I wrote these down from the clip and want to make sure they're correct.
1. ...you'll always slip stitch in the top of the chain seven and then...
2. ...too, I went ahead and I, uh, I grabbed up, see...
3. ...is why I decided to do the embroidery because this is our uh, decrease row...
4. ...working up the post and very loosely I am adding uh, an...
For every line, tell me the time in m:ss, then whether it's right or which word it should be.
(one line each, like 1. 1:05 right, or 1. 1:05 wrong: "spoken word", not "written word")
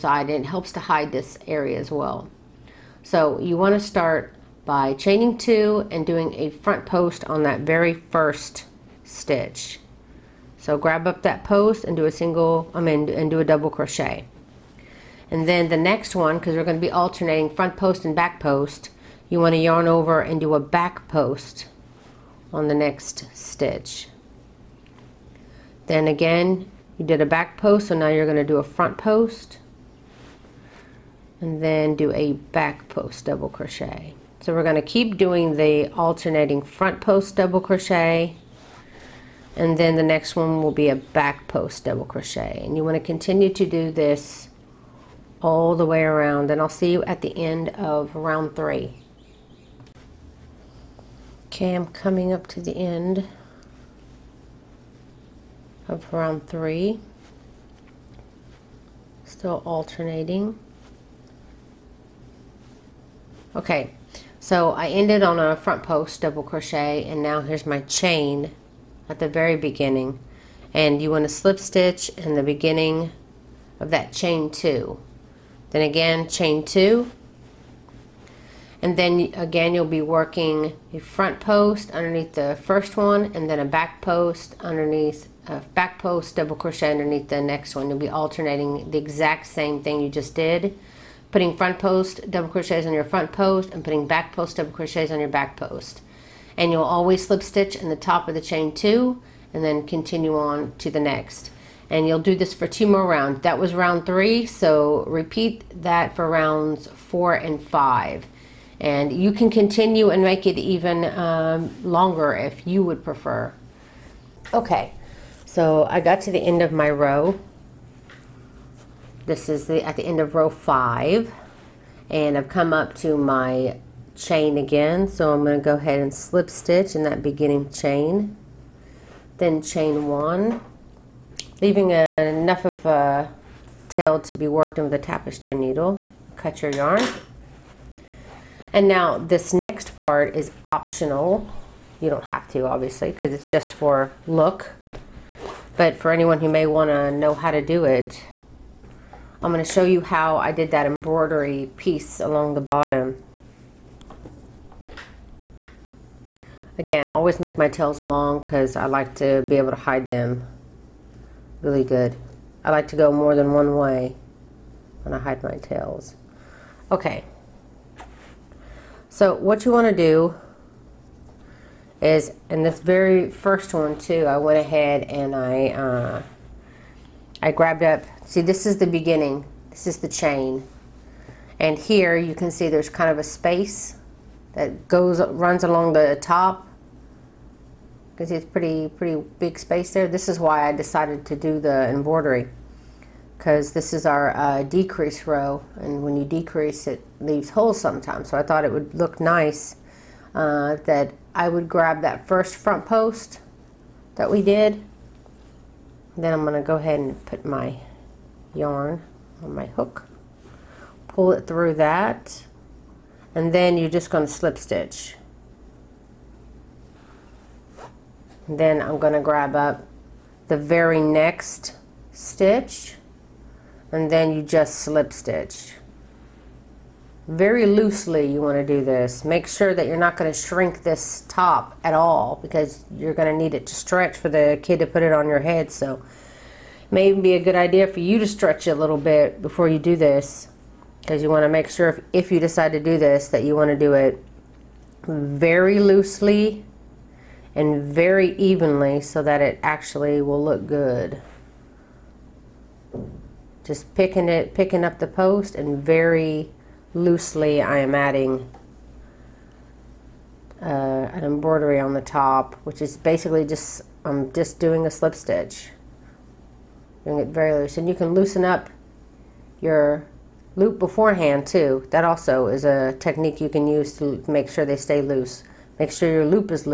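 1. 1:36 wrong: "two", not "seven"
2. 2:53 right
3. 3:10 right
4. 4:14 wrong: "picking", not "working".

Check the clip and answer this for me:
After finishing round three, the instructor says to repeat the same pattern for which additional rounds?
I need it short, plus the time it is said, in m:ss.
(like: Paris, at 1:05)
4 and 5, at 1:46.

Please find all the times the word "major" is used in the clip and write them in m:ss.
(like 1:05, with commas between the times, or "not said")
not said.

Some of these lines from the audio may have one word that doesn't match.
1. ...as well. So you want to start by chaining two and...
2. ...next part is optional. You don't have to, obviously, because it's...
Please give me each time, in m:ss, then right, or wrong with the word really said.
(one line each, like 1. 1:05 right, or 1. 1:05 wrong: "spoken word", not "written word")
1. 0:01 right
2. 2:19 right.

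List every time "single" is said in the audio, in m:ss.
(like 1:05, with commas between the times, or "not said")
0:12.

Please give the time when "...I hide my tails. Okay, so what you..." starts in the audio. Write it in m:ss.
2:45.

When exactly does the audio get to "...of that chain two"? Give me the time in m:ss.
1:13.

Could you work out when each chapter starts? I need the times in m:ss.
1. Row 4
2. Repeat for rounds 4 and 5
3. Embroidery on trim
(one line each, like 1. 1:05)
1. 1:14
2. 1:40
3. 2:17.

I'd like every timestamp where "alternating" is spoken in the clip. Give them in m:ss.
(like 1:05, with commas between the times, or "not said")
0:16, 0:35, 0:59, 1:28.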